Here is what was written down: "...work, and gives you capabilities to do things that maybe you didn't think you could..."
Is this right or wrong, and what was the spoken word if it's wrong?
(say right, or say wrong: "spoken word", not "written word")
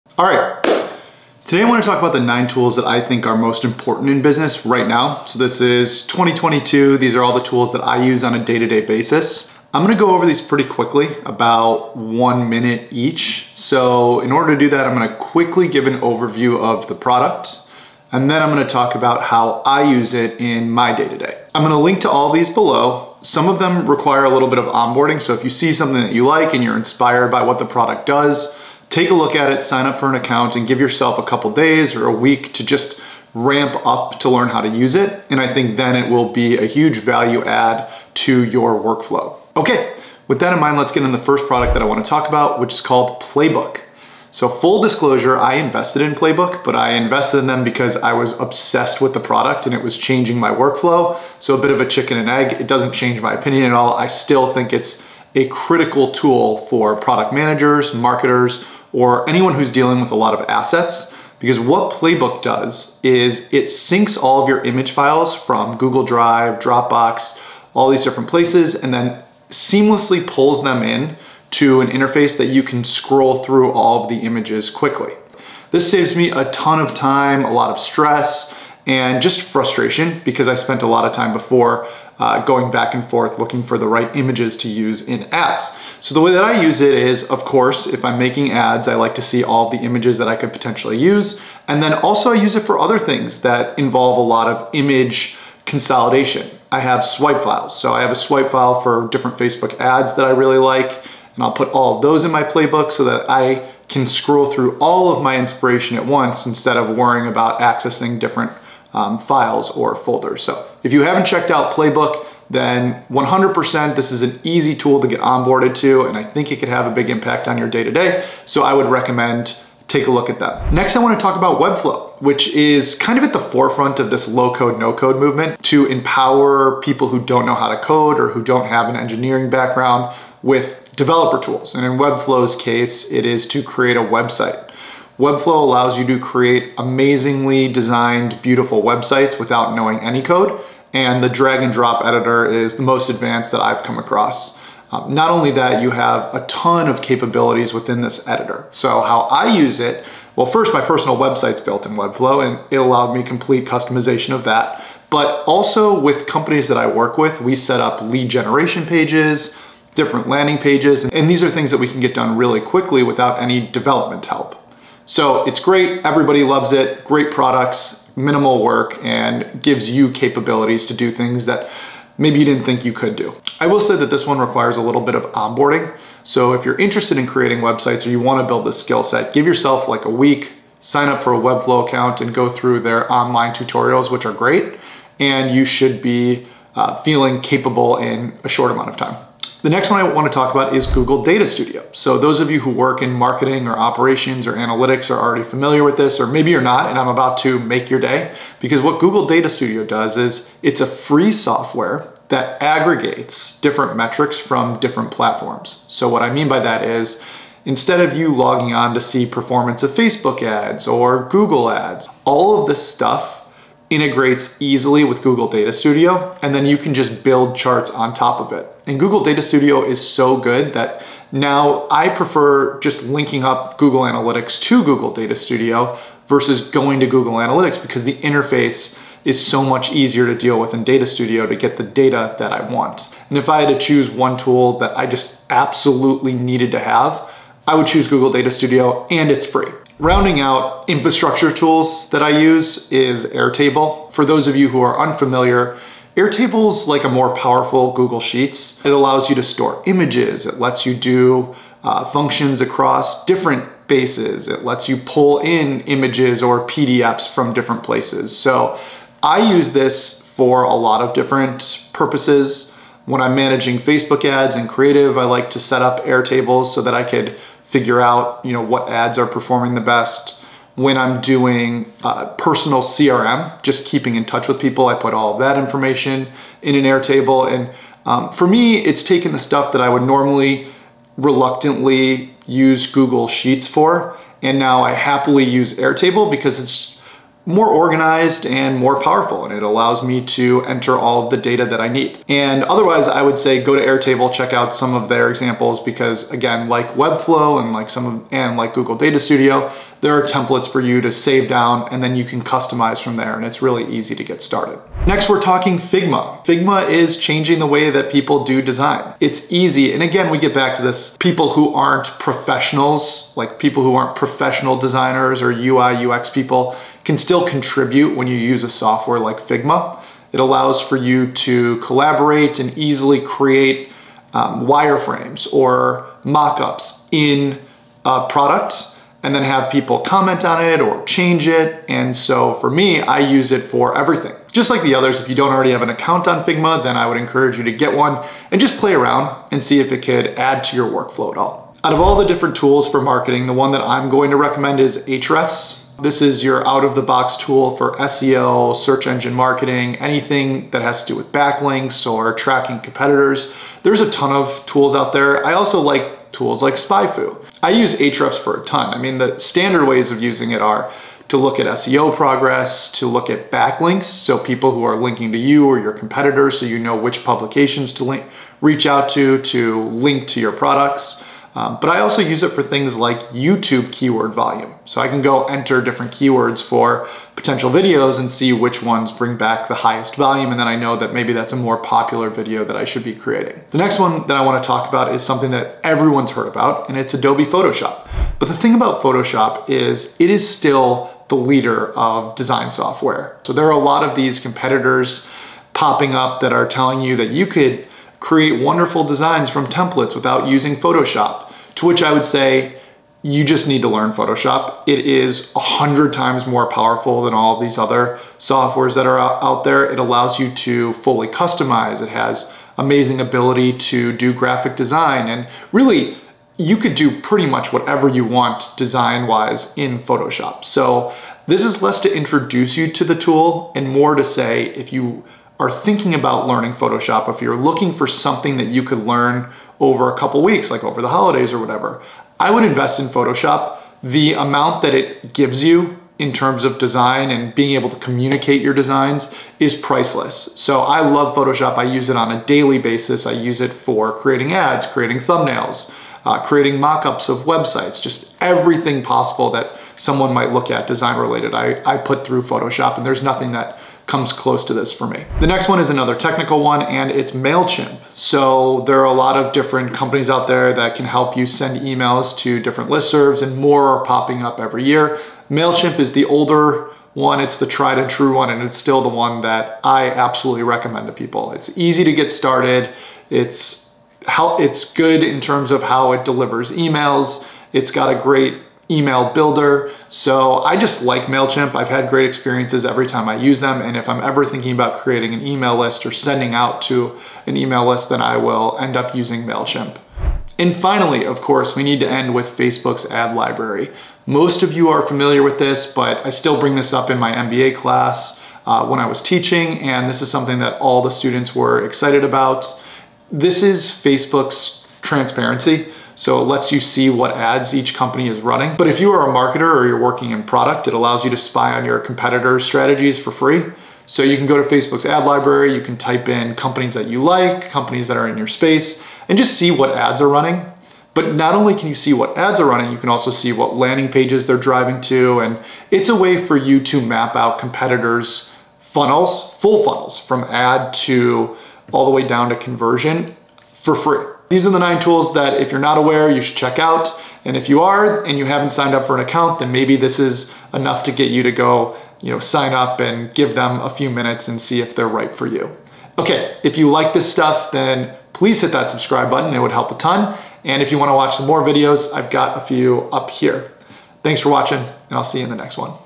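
right.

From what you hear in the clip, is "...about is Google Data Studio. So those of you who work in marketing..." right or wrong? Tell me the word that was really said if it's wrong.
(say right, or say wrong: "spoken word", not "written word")
right.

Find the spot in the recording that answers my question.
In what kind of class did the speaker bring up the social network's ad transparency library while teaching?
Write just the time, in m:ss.
8:17.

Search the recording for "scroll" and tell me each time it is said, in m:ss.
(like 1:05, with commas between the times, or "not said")
1:12, 1:44.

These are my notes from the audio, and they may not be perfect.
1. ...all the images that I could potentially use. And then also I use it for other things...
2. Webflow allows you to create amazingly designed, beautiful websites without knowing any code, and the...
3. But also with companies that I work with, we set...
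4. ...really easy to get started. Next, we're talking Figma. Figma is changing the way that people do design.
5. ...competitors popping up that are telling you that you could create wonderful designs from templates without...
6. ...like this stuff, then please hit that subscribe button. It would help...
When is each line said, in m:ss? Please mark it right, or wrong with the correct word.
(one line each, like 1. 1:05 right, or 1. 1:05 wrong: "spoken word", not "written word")
1. 1:29 right
2. 2:15 right
3. 2:35 right
4. 5:03 right
5. 6:34 right
6. 9:06 right.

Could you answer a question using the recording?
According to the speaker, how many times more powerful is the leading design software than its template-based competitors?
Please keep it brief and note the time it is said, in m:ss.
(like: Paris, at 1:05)
100, at 6:45.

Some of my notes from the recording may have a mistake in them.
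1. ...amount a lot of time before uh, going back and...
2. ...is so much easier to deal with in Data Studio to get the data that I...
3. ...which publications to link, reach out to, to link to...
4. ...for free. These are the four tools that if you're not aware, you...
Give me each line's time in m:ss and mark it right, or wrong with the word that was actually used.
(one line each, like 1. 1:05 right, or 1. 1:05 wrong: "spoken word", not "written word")
1. 1:20 wrong: "spent", not "amount"
2. 3:49 right
3. 6:06 right
4. 8:53 wrong: "nine", not "four".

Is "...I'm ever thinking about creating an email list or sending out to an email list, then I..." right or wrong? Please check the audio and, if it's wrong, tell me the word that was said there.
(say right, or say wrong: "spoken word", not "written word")
right.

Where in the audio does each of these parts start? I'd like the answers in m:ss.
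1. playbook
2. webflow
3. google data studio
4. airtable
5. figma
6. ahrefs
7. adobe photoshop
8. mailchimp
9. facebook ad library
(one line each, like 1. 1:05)
1. 0:51
2. 2:01
3. 3:12
4. 3:59
5. 5:03
6. 5:41
7. 6:28
8. 7:36
9. 8:10.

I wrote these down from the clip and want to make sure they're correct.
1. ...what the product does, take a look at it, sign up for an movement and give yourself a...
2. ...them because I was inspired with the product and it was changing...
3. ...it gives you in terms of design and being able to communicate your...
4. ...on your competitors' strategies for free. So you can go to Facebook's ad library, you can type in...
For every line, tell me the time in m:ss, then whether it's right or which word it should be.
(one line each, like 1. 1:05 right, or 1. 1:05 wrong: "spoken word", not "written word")
1. 0:27 wrong: "account", not "movement"
2. 0:47 wrong: "obsessed", not "inspired"
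3. 7:14 right
4. 8:31 right.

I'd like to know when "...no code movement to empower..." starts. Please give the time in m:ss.
2:04.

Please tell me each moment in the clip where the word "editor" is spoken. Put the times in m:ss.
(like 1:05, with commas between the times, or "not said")
2:22, 2:28.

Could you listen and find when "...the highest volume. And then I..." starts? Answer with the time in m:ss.
6:19.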